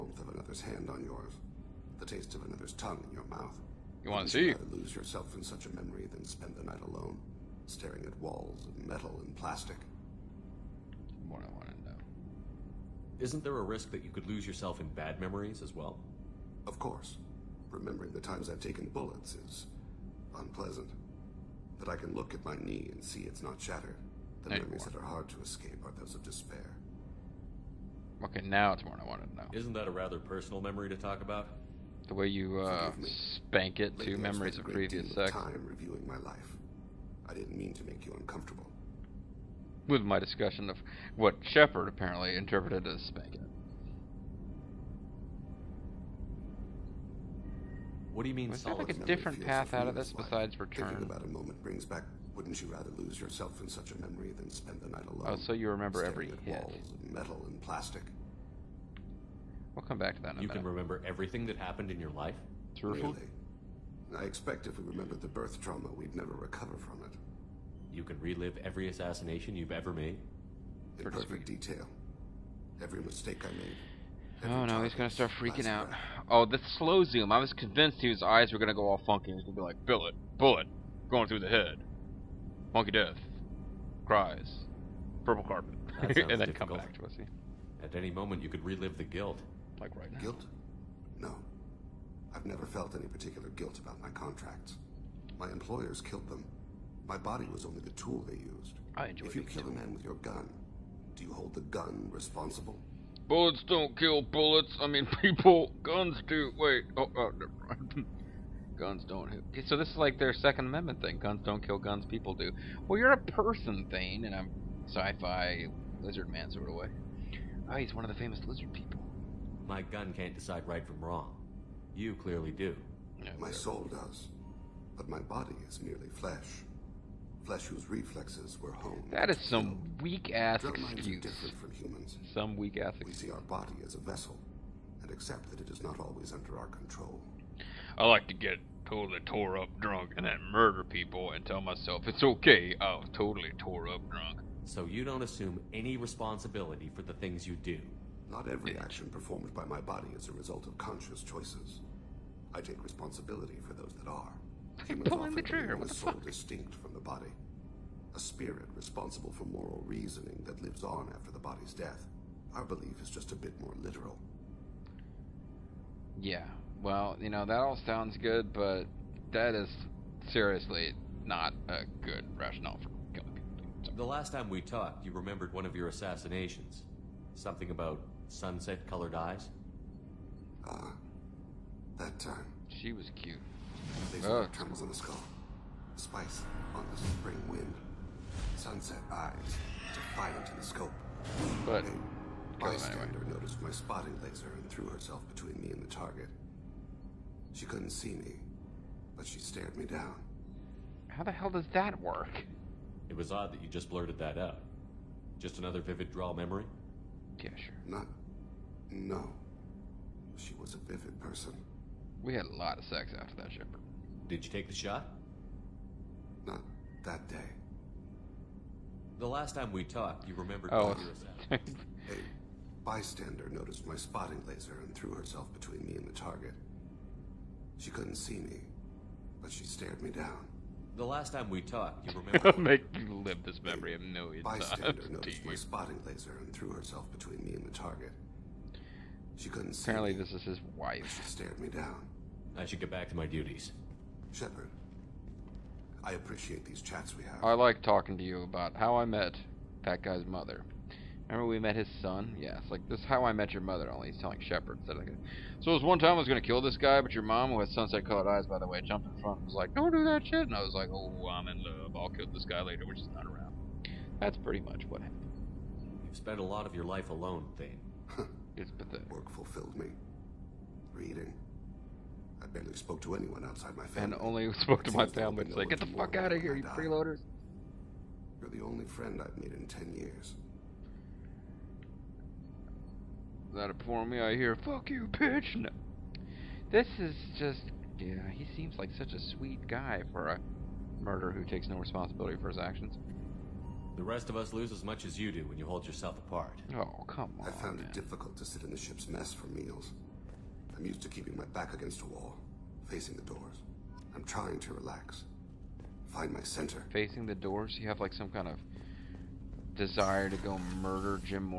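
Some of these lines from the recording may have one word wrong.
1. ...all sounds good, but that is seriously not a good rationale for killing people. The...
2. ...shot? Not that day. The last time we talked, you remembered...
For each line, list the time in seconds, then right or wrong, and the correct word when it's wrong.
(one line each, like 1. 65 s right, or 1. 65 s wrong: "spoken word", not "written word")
1. 167 s right
2. 214 s right.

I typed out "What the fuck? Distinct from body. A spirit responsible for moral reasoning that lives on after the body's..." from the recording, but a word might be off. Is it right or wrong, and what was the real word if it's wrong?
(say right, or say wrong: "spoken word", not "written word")
right.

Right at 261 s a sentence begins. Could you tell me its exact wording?
I'll kill this guy later, which is not around.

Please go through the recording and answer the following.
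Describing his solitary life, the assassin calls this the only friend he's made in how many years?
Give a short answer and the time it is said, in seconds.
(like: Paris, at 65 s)
10, at 279 s.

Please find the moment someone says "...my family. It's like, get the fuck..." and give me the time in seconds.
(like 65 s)
274 s.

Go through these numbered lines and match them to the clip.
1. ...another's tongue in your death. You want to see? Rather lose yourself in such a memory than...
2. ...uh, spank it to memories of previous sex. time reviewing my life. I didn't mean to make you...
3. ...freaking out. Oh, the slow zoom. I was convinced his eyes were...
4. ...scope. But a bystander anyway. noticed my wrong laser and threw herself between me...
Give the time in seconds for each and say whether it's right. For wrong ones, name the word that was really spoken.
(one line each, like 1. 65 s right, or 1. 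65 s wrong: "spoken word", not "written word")
1. 2 s wrong: "mouth", not "death"
2. 32 s right
3. 75 s right
4. 190 s wrong: "spotting", not "wrong".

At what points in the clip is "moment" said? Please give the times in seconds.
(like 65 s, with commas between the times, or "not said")
51 s, 88 s.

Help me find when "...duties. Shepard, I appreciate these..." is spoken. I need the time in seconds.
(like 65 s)
243 s.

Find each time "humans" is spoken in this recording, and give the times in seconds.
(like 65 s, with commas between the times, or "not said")
131 s.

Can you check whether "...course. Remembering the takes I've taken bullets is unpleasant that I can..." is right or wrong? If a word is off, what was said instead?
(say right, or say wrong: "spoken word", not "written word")
wrong: "times", not "takes".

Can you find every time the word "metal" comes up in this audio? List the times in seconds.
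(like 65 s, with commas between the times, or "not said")
8 s, 57 s.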